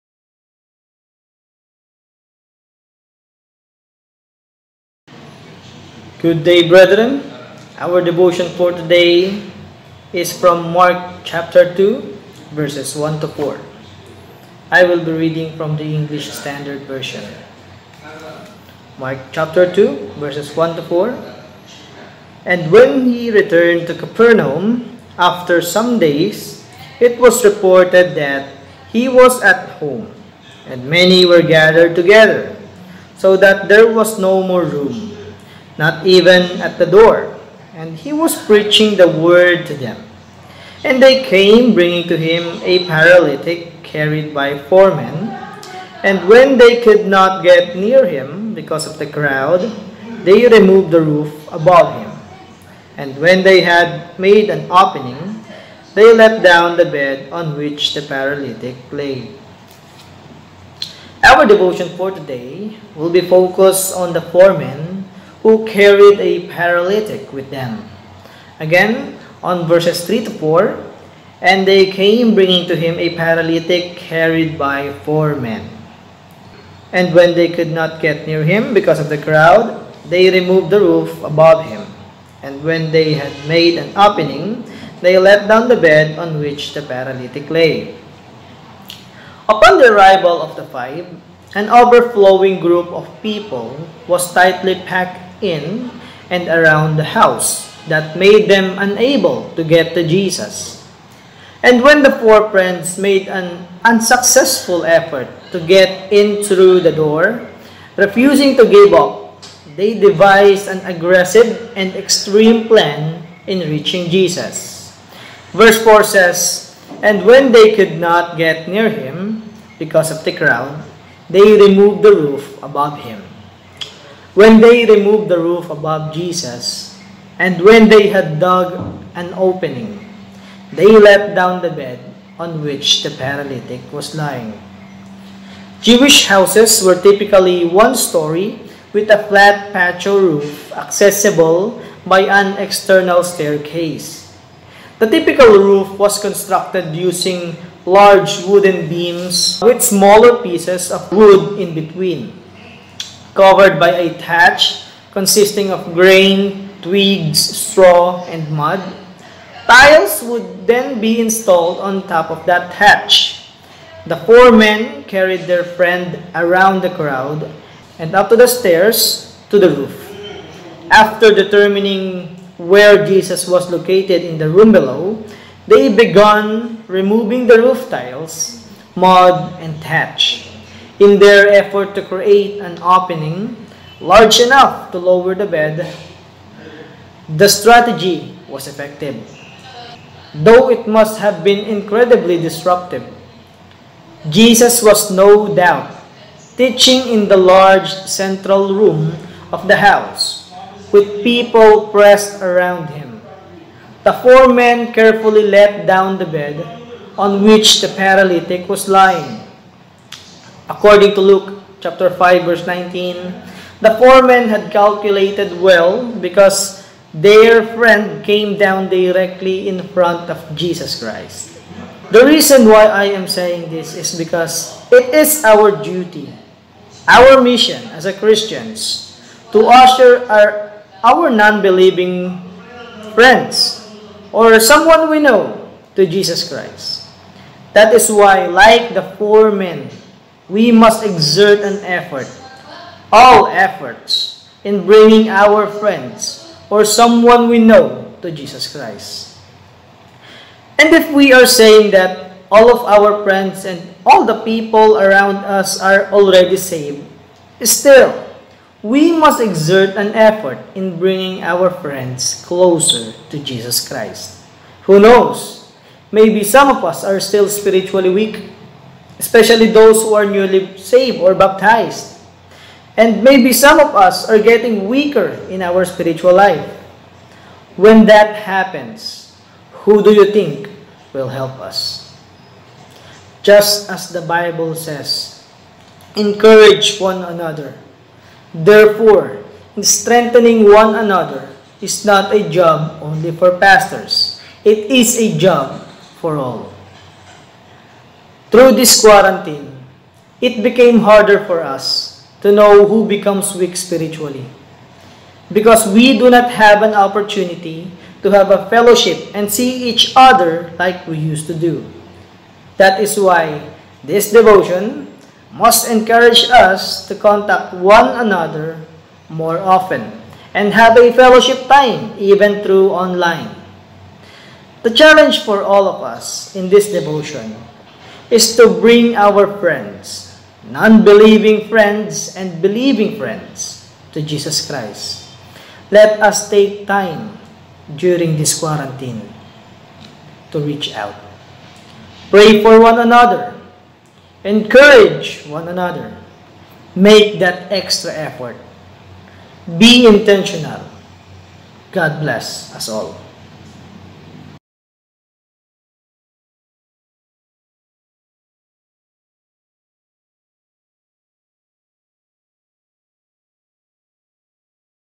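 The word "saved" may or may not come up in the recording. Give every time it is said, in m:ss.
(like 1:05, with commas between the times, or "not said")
4:16, 4:30.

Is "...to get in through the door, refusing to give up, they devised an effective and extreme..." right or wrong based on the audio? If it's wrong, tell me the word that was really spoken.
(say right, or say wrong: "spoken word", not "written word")
wrong: "aggressive", not "effective".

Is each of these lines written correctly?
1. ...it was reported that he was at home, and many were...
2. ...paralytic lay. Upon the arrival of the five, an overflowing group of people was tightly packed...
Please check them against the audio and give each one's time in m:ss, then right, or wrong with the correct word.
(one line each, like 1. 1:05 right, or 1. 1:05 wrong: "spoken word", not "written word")
1. 0:27 right
2. 1:26 right.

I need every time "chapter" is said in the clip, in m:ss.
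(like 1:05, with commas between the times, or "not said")
0:11, 0:19, 3:31.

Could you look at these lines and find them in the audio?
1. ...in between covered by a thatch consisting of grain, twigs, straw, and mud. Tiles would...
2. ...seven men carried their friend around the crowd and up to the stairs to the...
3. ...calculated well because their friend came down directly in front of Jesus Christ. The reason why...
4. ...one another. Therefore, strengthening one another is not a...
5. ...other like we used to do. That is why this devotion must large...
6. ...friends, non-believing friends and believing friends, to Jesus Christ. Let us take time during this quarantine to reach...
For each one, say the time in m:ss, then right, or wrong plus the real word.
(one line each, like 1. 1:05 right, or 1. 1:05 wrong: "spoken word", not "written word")
1. 2:31 right
2. 2:44 wrong: "four", not "seven"
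3. 3:34 right
4. 4:46 right
5. 5:10 wrong: "encourage", not "large"
6. 5:29 right.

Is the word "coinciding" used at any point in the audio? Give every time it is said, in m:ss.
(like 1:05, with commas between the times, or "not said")
not said.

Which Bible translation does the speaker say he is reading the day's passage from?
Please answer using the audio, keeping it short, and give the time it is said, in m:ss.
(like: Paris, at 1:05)
English Standard Version, at 0:15.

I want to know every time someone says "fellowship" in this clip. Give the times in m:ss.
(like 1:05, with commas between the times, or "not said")
5:08, 5:21.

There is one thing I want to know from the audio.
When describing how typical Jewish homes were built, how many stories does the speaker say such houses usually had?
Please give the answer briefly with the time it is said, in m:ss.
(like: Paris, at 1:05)
1, at 2:17.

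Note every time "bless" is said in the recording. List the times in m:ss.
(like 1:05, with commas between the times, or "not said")
5:52.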